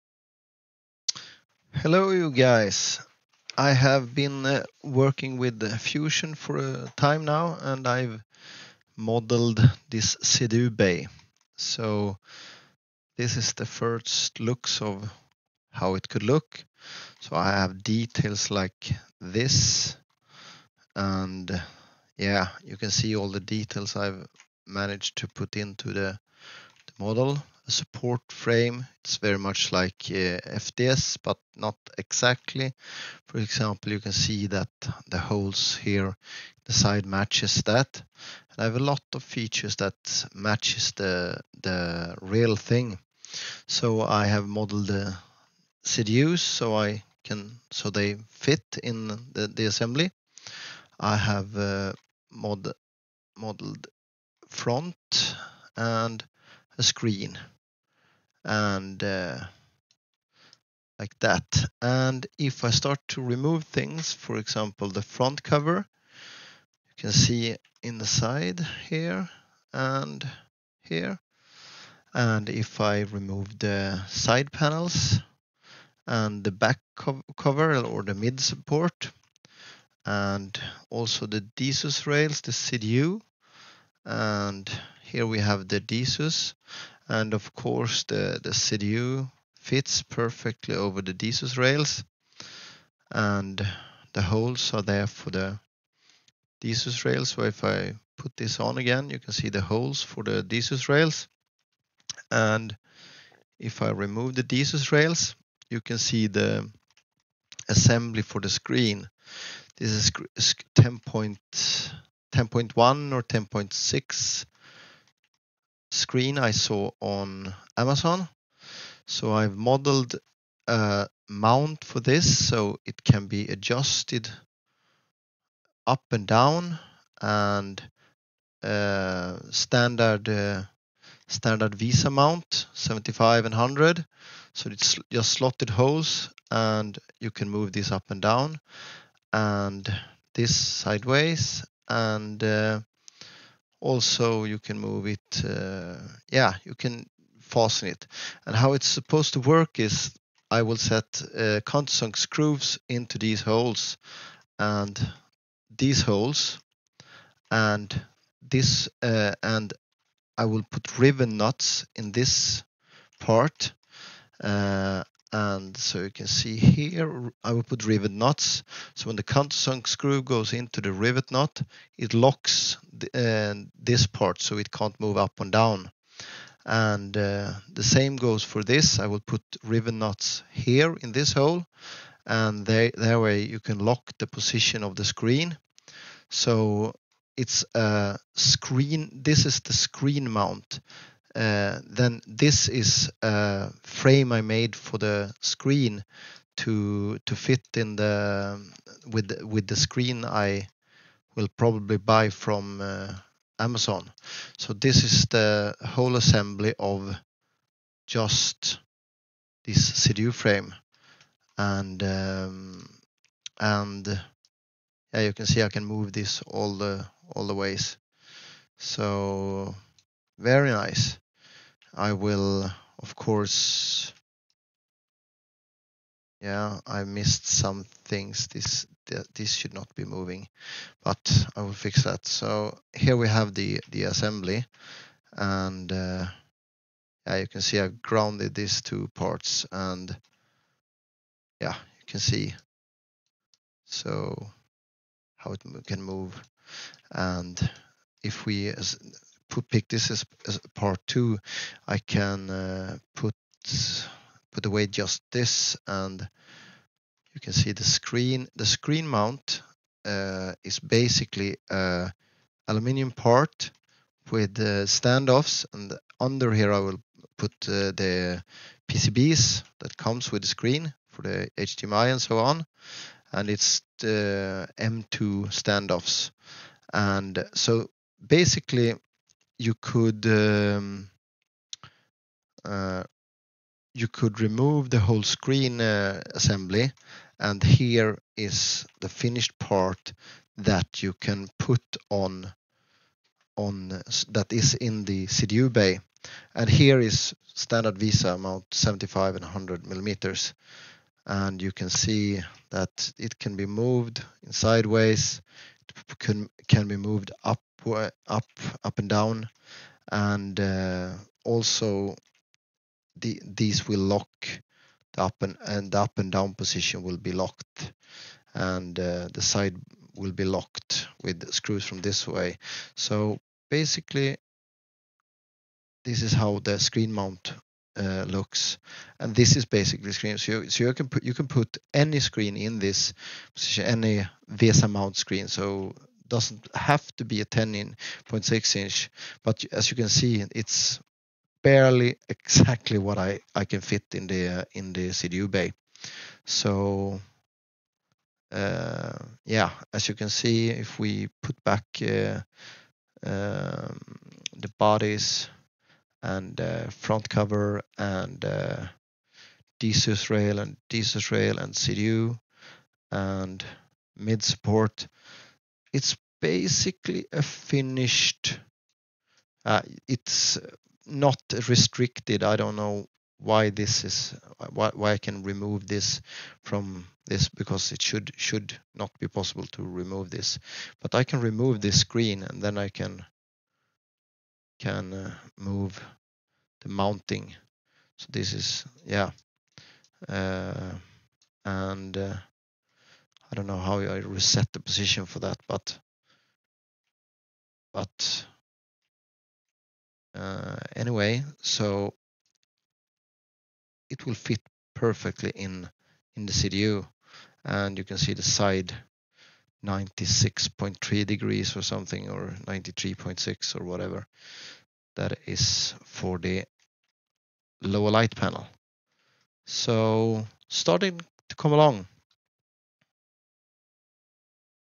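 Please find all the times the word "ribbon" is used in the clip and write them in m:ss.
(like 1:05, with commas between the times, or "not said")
2:40, 2:59.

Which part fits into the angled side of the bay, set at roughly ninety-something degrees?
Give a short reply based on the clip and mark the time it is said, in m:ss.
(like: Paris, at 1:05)
lower light panel, at 6:57.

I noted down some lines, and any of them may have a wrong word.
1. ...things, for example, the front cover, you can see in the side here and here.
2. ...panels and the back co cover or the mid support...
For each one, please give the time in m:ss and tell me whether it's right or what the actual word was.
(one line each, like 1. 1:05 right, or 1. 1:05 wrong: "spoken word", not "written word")
1. 1:03 right
2. 1:14 right.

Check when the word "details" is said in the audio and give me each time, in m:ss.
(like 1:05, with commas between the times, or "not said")
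0:17, 0:23.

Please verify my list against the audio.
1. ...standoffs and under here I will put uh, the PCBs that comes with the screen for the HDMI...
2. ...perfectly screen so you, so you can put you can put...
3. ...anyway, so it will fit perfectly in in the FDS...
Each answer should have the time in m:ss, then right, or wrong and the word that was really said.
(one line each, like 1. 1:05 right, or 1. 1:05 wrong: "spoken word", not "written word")
1. 4:24 right
2. 5:29 wrong: "basically", not "perfectly"
3. 6:40 wrong: "CDU", not "FDS".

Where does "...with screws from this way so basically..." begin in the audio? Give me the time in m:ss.
5:21.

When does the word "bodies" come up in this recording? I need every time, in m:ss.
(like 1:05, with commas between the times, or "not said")
5:54.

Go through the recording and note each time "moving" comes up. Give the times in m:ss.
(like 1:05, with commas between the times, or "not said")
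3:50.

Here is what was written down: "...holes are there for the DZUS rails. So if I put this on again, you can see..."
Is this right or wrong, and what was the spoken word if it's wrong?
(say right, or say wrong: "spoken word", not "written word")
right.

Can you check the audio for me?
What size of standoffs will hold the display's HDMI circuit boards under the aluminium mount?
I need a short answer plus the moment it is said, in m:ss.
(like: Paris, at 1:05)
M2, at 4:34.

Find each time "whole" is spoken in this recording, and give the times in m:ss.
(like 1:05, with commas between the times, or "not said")
3:25, 4:44.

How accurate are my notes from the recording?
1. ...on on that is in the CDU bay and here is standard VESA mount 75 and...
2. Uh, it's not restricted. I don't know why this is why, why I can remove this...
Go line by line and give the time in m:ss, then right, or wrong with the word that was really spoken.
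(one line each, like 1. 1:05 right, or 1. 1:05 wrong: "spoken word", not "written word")
1. 4:52 right
2. 6:09 right.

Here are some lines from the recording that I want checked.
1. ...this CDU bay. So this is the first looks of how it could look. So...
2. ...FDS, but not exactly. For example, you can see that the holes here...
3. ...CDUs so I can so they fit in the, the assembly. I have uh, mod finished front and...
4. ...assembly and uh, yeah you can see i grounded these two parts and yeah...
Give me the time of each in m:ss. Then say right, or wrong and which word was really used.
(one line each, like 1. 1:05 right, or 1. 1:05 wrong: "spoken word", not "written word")
1. 0:09 right
2. 0:30 right
3. 0:45 wrong: "modeled", not "finished"
4. 3:54 right.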